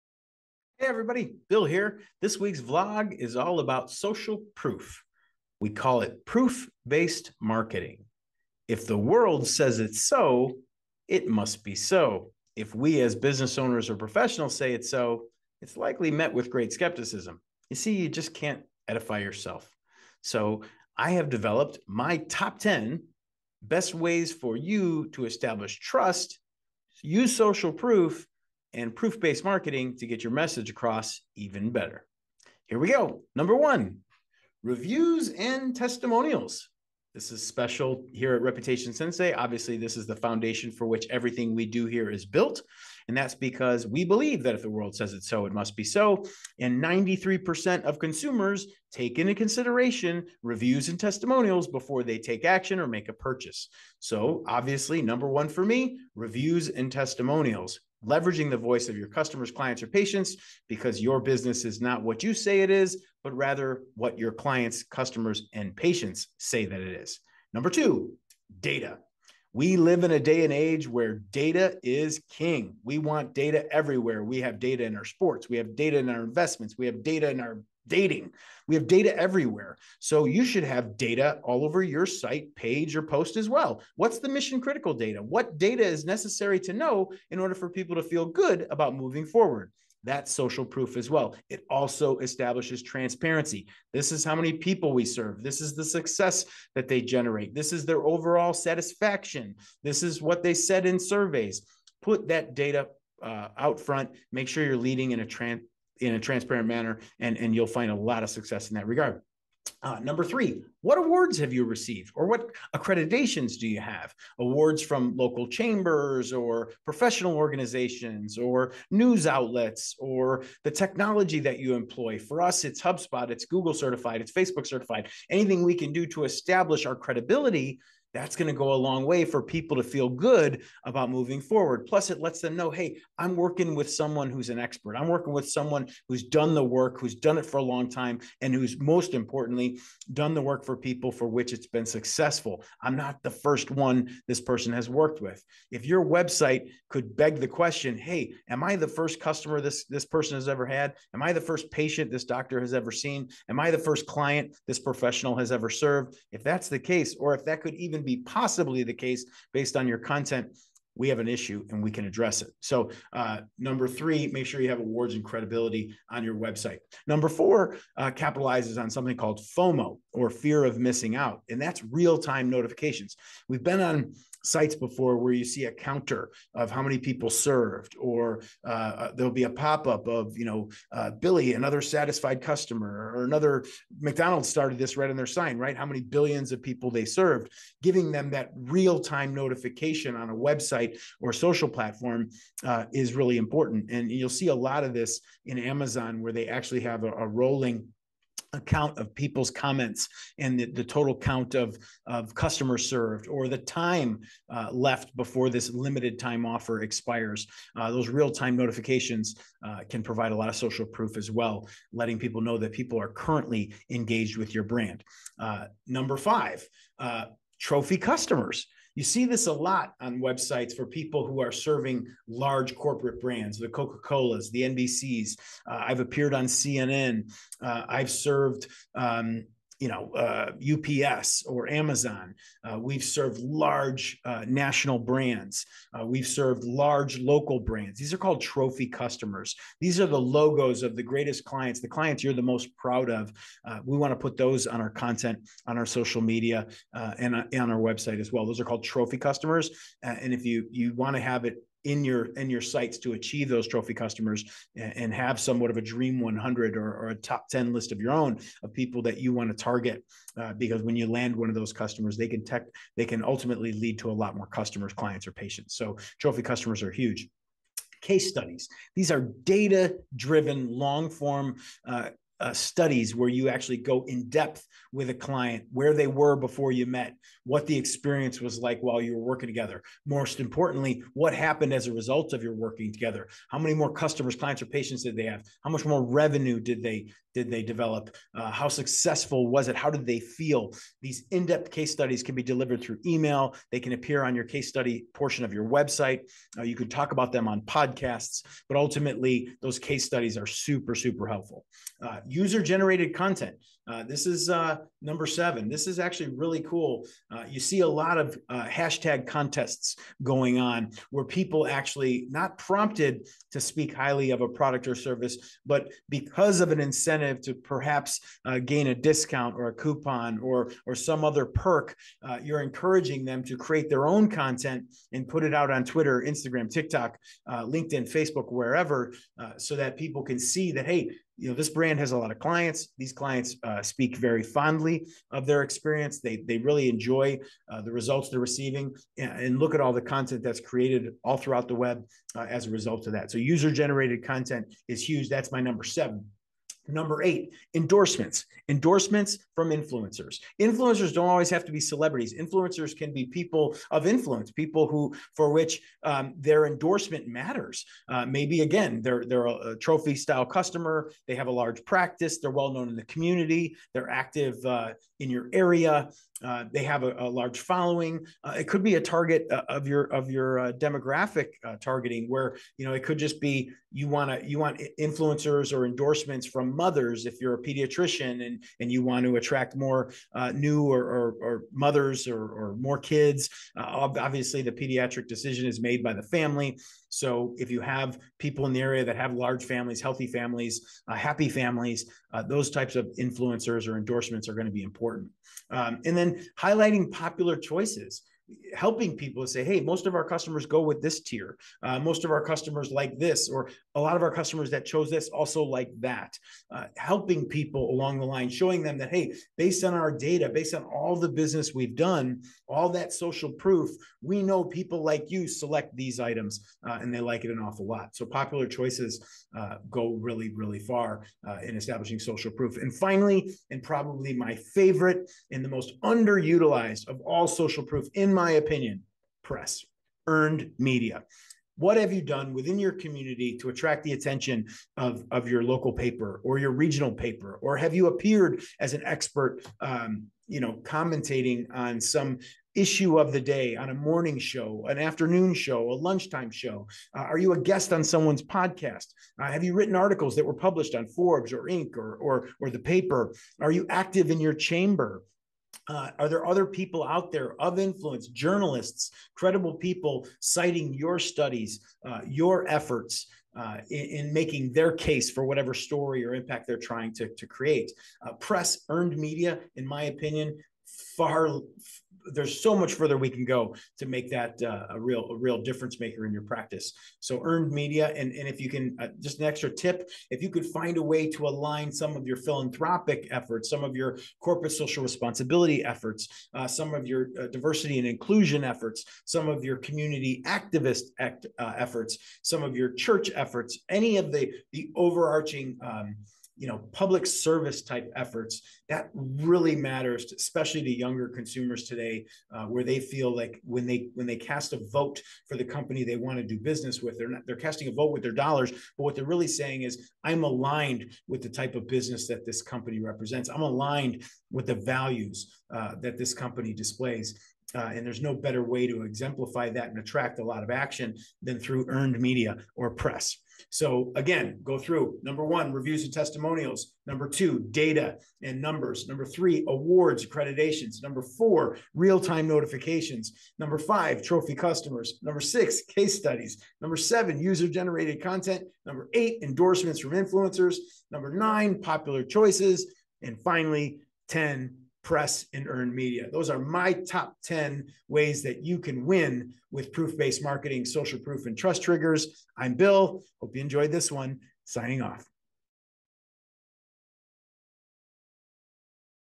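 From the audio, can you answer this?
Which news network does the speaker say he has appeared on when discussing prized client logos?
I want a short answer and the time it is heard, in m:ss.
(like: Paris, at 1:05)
CNN, at 3:46.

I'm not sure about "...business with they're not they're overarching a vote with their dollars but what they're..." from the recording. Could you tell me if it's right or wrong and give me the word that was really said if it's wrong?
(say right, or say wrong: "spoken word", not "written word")
wrong: "casting", not "overarching".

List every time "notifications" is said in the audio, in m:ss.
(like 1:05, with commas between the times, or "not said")
2:52, 3:09, 3:28, 8:52.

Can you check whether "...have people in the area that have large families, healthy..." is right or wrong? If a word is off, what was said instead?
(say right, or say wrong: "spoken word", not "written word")
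right.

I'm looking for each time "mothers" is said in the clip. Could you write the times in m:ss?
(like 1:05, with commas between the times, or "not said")
6:16, 6:21.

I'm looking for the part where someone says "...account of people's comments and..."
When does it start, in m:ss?
3:18.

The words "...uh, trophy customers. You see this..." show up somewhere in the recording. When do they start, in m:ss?
3:36.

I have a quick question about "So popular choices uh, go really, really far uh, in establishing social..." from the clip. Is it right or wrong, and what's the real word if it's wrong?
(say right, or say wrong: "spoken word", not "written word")
right.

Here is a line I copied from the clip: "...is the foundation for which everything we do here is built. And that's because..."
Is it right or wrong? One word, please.
right.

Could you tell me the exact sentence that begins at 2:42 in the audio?
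So, uh, number three, make sure you have awards and credibility on your website.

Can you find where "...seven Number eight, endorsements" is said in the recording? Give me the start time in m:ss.
5:45.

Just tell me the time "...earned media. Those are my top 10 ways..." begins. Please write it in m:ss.
9:05.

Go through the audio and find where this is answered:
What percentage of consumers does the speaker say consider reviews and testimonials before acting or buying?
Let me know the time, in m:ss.
0:46.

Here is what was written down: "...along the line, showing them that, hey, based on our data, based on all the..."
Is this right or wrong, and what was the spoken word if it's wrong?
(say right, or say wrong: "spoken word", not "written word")
right.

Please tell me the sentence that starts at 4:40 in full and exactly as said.
Most importantly, what happened as a result of your working together?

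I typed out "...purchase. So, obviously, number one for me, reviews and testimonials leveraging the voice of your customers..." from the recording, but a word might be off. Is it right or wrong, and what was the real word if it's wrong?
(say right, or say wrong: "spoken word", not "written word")
right.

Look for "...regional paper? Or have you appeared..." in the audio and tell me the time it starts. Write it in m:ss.
7:16.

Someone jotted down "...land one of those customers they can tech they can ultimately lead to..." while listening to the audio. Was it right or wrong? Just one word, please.
right.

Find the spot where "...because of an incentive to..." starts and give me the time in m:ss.
5:16.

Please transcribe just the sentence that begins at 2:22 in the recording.
I'm not the first one this person has worked with.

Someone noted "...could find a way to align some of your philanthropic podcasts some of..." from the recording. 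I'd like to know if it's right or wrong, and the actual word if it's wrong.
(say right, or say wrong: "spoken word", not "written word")
wrong: "efforts", not "podcasts".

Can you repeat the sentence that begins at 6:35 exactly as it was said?
Um, and then highlighting popular choices helping people to say, hey, most of our customers go with this tier.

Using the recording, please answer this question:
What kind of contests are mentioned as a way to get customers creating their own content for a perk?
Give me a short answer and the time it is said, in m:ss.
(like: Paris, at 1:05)
hashtag contests, at 5:08.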